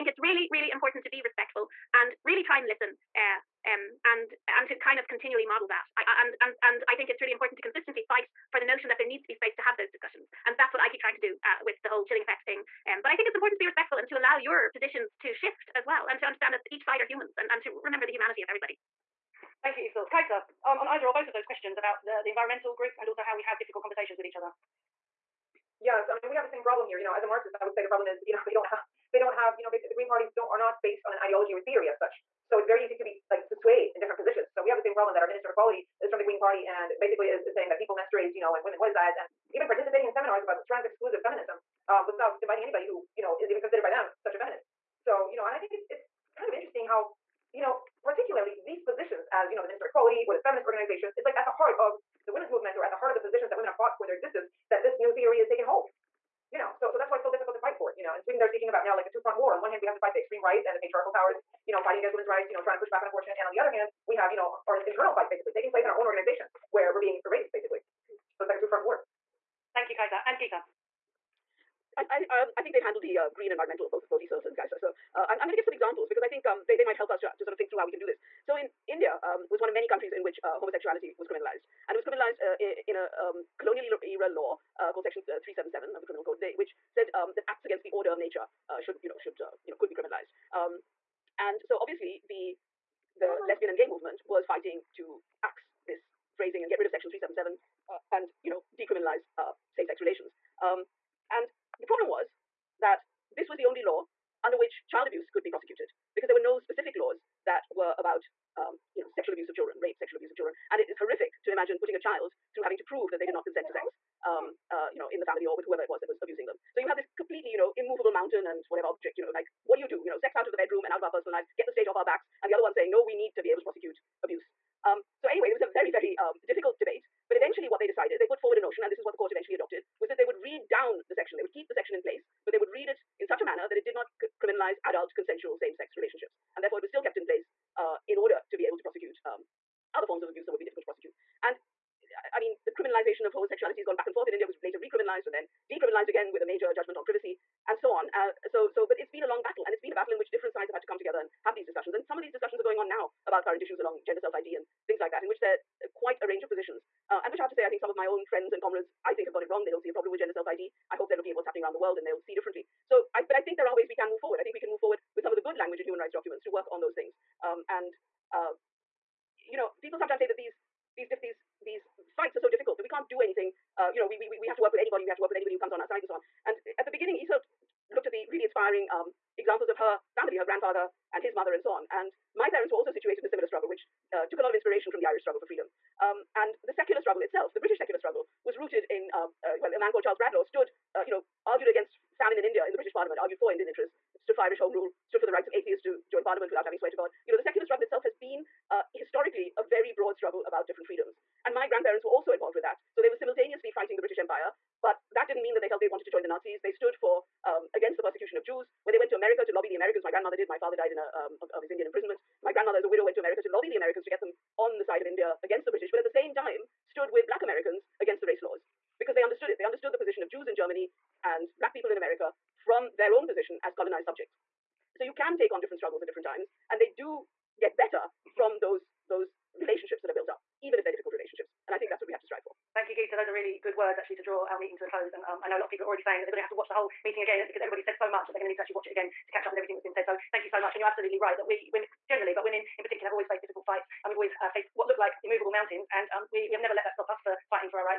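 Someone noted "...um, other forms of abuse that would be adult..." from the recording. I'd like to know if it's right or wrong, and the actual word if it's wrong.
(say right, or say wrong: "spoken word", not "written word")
wrong: "difficult", not "adult".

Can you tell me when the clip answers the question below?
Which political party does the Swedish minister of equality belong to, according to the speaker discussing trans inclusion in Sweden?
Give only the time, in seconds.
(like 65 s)
36 s.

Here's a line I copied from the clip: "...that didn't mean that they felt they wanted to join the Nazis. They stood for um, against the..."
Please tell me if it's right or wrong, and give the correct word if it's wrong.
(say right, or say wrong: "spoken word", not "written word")
right.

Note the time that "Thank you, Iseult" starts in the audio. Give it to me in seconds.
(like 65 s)
19 s.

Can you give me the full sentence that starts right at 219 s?
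They understood the position of Jews in Germany and Black people in America from their own position as colonized subjects.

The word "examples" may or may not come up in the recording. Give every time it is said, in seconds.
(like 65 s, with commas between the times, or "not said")
75 s, 179 s.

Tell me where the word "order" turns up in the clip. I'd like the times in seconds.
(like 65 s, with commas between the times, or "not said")
87 s, 138 s.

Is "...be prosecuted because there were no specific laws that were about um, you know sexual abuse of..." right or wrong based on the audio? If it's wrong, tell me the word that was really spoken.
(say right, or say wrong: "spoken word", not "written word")
right.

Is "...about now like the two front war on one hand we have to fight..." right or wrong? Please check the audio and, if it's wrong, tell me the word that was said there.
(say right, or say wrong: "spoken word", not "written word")
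right.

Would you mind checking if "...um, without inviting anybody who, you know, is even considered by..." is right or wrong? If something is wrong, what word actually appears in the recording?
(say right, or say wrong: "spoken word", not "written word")
right.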